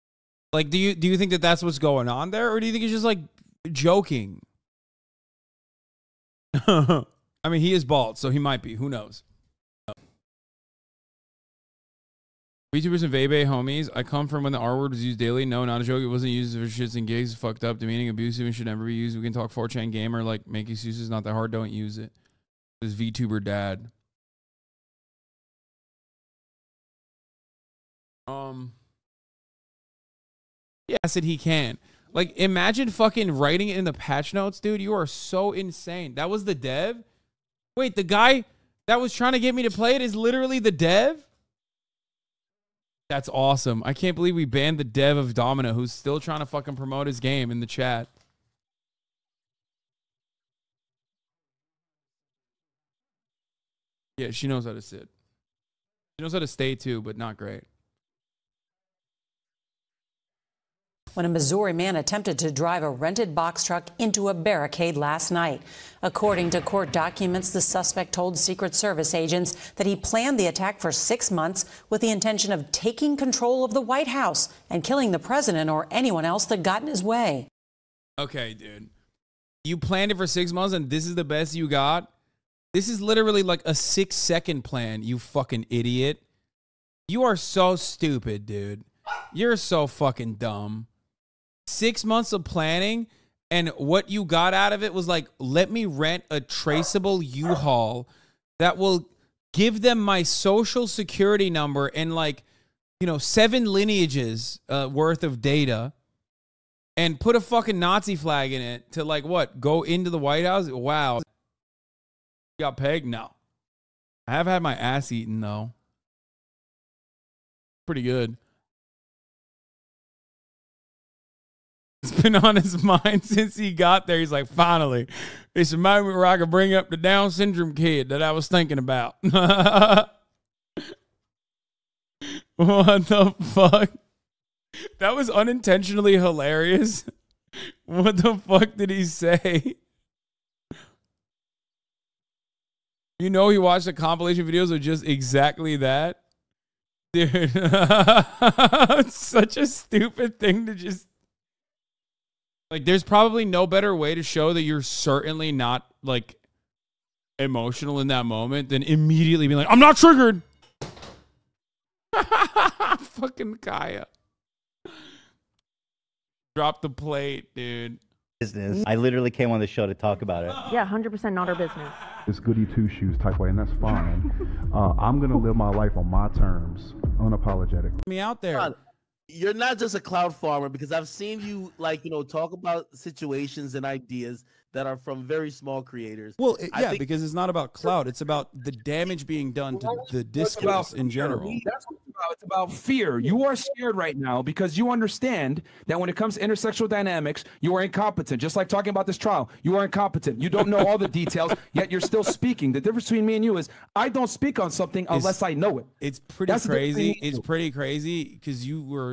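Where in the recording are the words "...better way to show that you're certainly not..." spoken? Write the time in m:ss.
2:33.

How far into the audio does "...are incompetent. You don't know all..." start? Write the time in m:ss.
3:19.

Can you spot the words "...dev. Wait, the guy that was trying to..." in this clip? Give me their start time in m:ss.
0:36.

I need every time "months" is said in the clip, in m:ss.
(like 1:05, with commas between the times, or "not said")
1:11, 1:20, 1:32.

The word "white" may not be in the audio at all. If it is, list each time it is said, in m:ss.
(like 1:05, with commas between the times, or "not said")
1:13, 1:50.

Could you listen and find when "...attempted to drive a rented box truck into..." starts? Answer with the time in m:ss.
1:01.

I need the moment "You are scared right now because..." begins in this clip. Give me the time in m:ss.
3:13.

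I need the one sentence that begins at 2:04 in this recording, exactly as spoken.
He's like, finally, it's a moment where I can bring up the Down syndrome kid that I was thinking about.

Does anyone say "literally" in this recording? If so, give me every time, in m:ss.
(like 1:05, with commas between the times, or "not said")
0:40, 1:23, 2:48.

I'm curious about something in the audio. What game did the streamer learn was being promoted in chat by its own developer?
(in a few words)
Domino.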